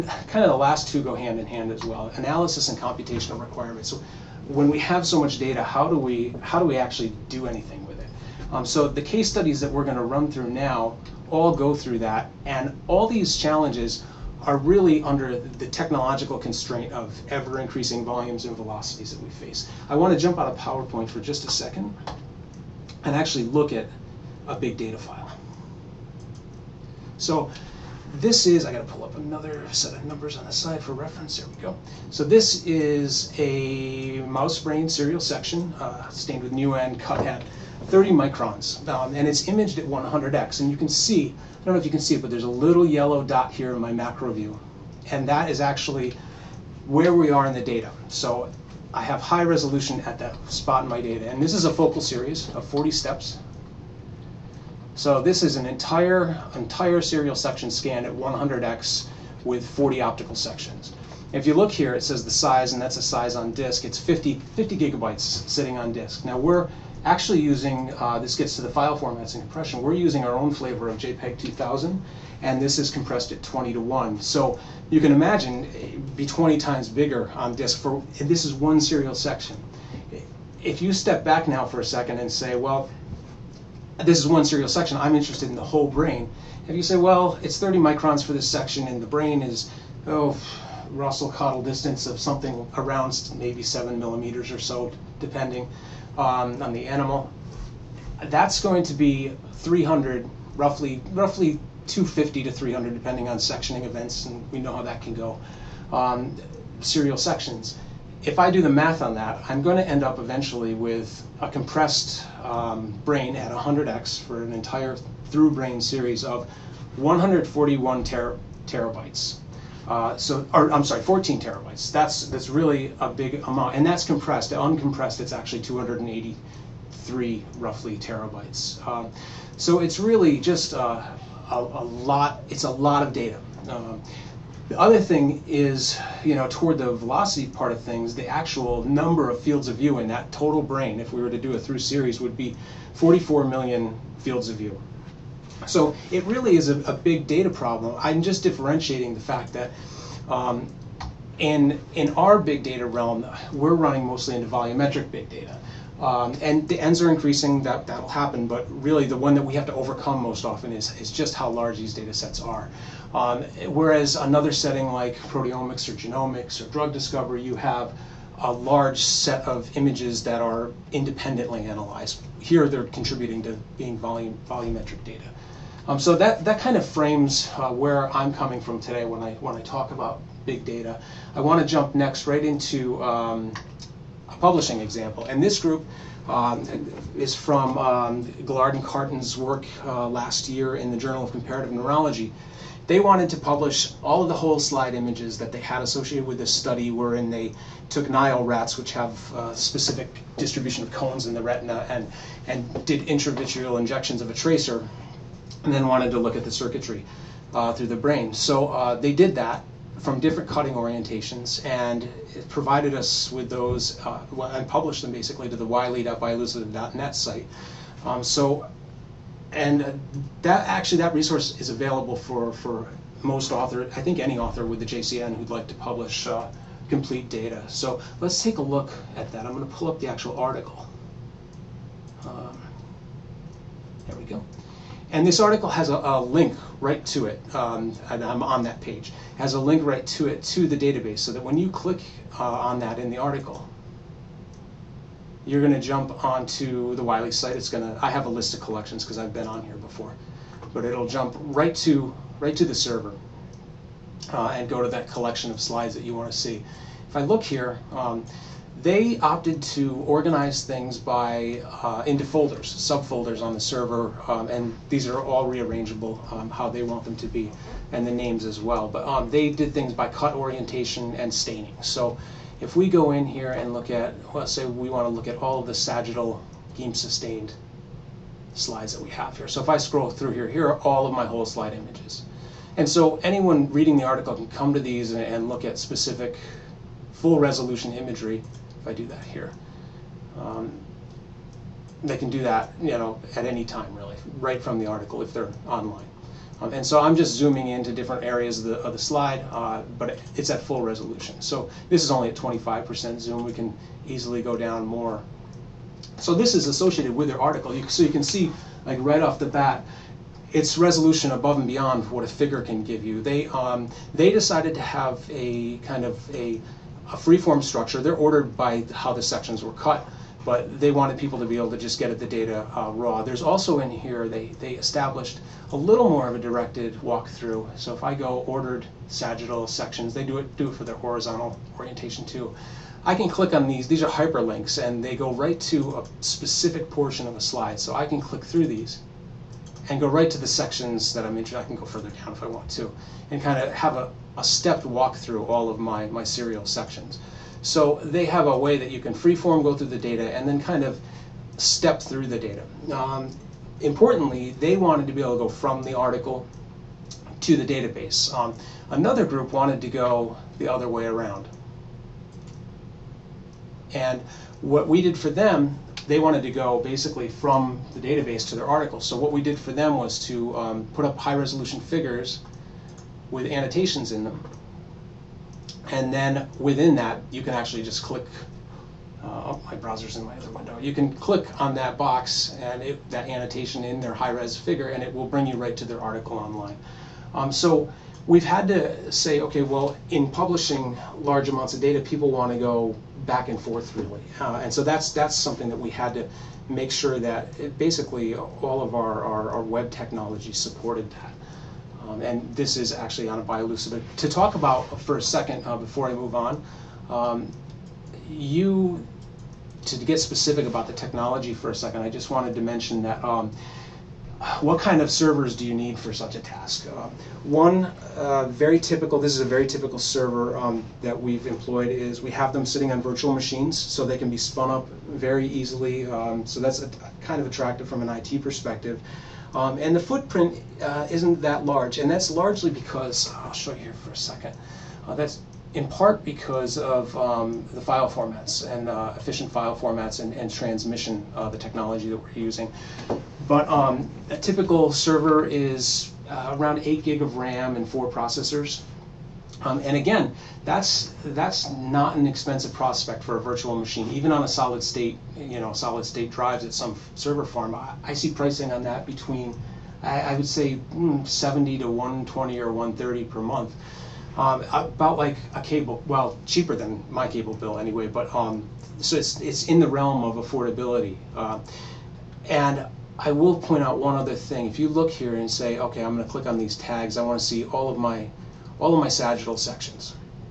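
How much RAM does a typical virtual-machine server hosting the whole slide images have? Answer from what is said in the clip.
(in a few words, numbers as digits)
8 GB.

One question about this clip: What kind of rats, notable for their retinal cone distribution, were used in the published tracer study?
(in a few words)
Nile rats.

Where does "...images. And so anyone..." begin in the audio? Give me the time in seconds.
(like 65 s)
281 s.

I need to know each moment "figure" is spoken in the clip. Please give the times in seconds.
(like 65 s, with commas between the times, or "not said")
312 s, 371 s, 384 s.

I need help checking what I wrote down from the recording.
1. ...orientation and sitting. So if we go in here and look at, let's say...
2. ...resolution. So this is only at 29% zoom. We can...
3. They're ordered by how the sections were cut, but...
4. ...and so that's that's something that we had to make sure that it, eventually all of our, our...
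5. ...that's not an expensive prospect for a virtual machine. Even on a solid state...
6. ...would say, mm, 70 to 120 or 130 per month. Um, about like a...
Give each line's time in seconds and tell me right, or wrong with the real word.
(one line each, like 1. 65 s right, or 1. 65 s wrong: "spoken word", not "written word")
1. 270 s wrong: "staining", not "sitting"
2. 300 s wrong: "25", not "29"
3. 317 s right
4. 394 s wrong: "basically", not "eventually"
5. 451 s right
6. 460 s right.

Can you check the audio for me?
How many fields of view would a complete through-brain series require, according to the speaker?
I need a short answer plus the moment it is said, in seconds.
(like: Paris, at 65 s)
44 million, at 142 s.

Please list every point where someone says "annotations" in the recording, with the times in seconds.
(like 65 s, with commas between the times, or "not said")
373 s, 383 s.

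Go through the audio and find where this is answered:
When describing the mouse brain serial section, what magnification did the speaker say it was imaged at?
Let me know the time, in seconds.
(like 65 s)
39 s.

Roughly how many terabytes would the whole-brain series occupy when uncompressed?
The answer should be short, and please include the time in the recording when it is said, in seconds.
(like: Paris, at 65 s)
283, at 125 s.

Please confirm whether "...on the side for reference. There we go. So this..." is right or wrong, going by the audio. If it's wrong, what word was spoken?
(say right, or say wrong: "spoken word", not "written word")
right.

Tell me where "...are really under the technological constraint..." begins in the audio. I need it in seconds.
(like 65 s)
14 s.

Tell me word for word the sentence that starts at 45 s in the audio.
And that is actually where we are in the data.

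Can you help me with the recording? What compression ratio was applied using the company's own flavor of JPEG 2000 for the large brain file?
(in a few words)
20 to 1.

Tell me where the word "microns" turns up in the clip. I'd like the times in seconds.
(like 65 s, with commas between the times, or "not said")
38 s, 87 s.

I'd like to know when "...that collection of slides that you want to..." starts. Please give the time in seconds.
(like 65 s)
254 s.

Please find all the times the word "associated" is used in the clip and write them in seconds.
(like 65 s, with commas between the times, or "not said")
195 s, 306 s.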